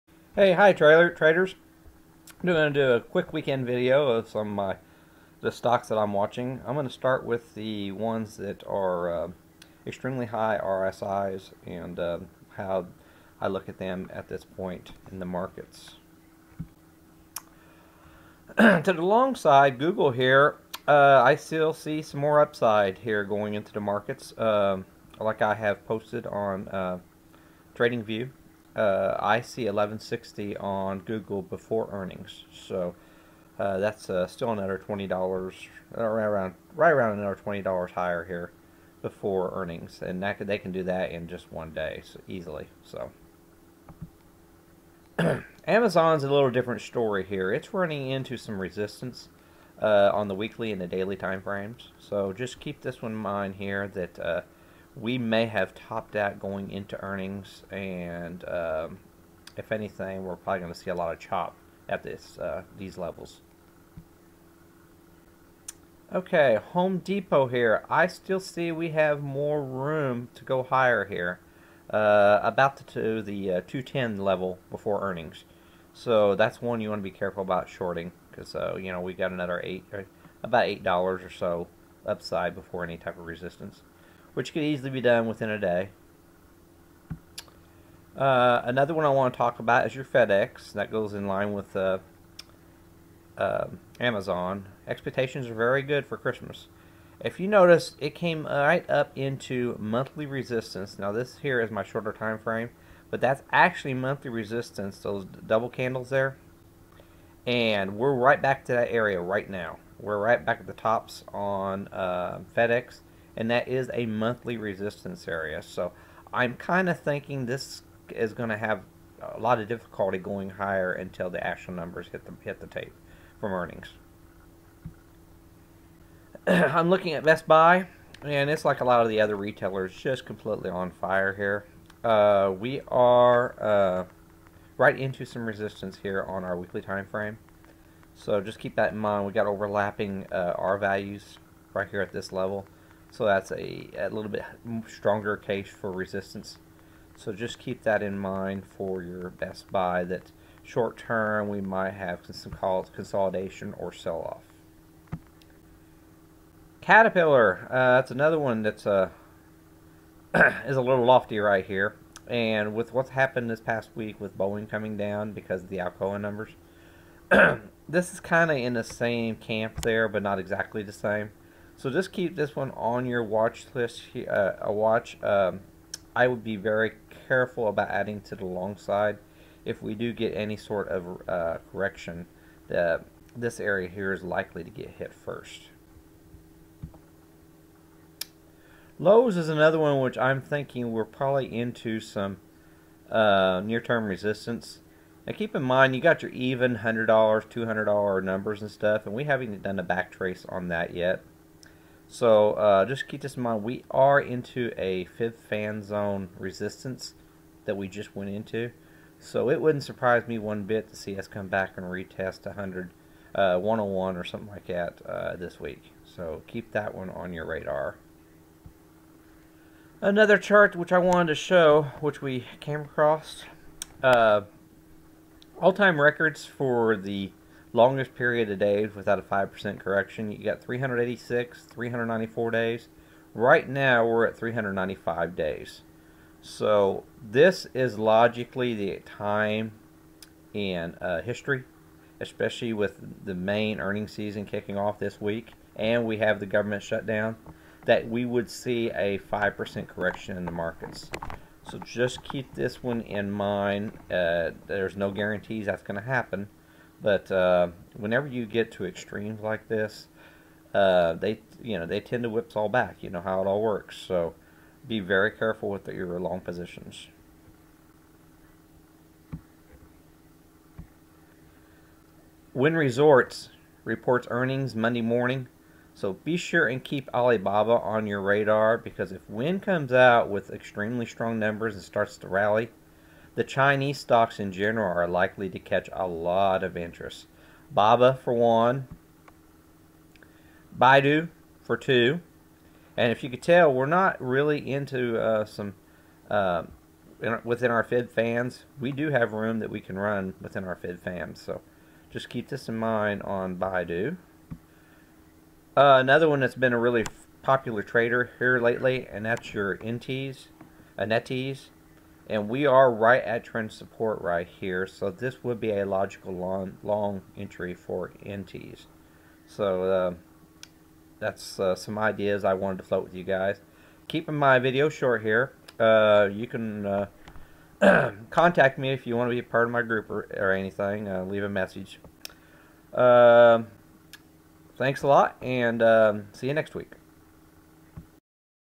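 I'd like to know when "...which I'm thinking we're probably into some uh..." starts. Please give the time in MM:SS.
03:09.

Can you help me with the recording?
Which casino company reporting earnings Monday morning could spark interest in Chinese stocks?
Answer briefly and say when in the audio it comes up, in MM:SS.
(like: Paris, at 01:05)
Wynn Resorts, at 04:32.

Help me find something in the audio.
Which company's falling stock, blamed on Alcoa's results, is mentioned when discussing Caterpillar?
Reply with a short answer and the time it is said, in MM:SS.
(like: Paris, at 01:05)
Boeing, at 02:44.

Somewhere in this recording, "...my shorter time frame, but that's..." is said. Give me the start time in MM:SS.
01:41.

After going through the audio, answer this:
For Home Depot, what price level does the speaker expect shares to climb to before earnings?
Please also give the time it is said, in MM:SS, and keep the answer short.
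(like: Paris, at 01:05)
210, at 01:13.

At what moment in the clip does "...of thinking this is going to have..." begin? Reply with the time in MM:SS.
01:56.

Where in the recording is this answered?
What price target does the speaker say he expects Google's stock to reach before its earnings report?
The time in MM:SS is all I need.
00:29.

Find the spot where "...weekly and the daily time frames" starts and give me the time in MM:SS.
00:50.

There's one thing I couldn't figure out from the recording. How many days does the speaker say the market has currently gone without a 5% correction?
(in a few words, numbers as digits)
395.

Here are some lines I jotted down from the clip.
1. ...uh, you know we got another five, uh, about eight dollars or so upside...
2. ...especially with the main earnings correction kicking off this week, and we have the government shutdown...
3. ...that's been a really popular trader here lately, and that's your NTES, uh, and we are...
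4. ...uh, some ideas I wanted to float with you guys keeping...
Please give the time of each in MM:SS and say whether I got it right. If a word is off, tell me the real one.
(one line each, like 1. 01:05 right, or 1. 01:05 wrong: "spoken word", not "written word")
1. 01:18 wrong: "eight", not "five"
2. 04:02 wrong: "season", not "correction"
3. 05:06 right
4. 05:21 right.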